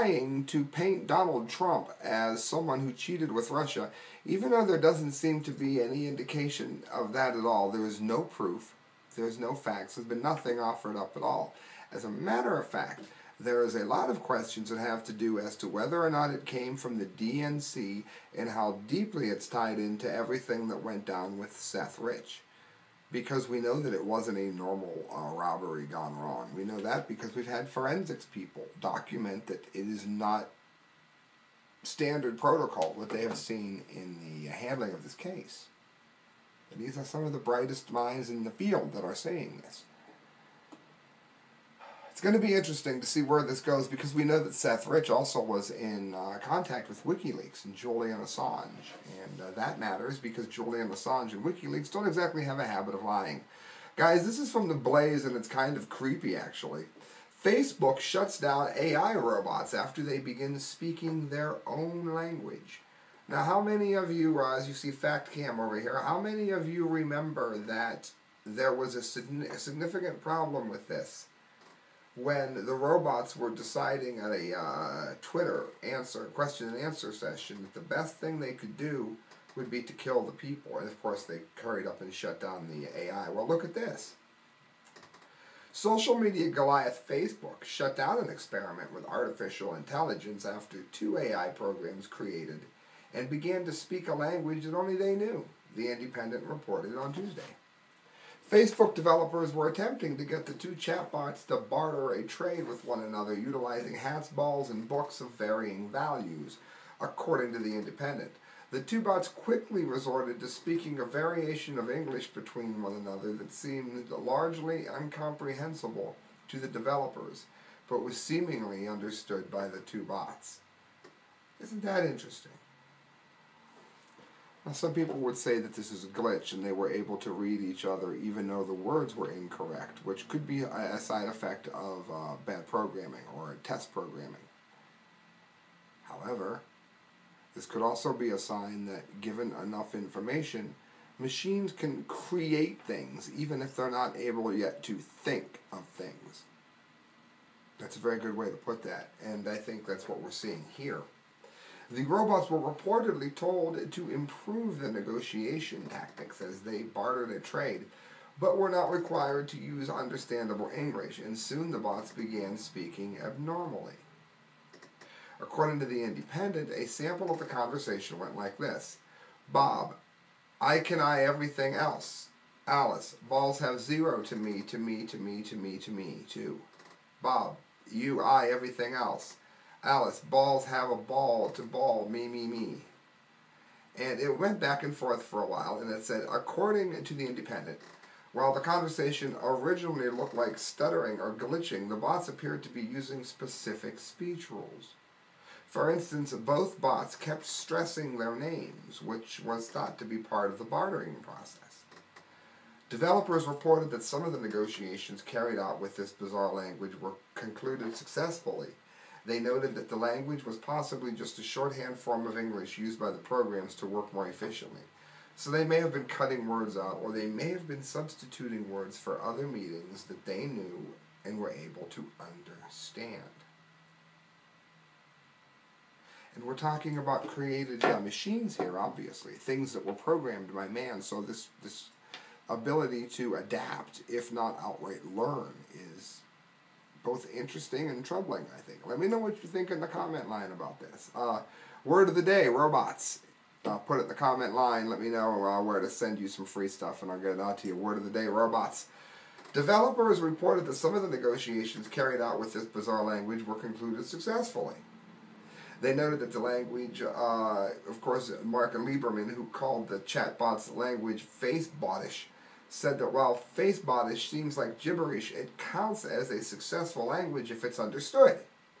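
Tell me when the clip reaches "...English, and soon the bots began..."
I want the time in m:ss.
2:40.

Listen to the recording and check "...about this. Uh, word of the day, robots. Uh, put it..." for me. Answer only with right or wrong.
right.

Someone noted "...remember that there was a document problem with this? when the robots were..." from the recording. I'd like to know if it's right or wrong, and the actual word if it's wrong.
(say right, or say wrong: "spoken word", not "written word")
wrong: "significant", not "document".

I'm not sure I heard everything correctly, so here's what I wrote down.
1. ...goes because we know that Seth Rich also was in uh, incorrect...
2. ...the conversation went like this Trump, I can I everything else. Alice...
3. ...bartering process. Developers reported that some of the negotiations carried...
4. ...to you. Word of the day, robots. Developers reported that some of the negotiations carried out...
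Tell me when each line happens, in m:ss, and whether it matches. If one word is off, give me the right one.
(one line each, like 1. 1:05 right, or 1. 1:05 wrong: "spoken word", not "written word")
1. 0:43 wrong: "contact", not "incorrect"
2. 2:47 wrong: "Bob", not "Trump"
3. 3:20 right
4. 4:07 right.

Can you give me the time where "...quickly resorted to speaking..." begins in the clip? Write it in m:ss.
1:49.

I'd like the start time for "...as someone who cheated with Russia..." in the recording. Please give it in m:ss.
0:02.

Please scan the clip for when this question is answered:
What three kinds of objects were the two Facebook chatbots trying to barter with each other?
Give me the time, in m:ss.
1:43.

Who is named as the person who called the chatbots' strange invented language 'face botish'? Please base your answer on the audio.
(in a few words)
Mark Liberman.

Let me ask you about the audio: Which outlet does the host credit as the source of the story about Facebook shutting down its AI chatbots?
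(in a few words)
The Blaze.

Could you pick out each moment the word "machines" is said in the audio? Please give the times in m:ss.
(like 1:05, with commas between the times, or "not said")
2:21, 3:48.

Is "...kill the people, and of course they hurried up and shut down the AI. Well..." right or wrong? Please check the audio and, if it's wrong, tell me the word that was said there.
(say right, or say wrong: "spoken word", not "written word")
right.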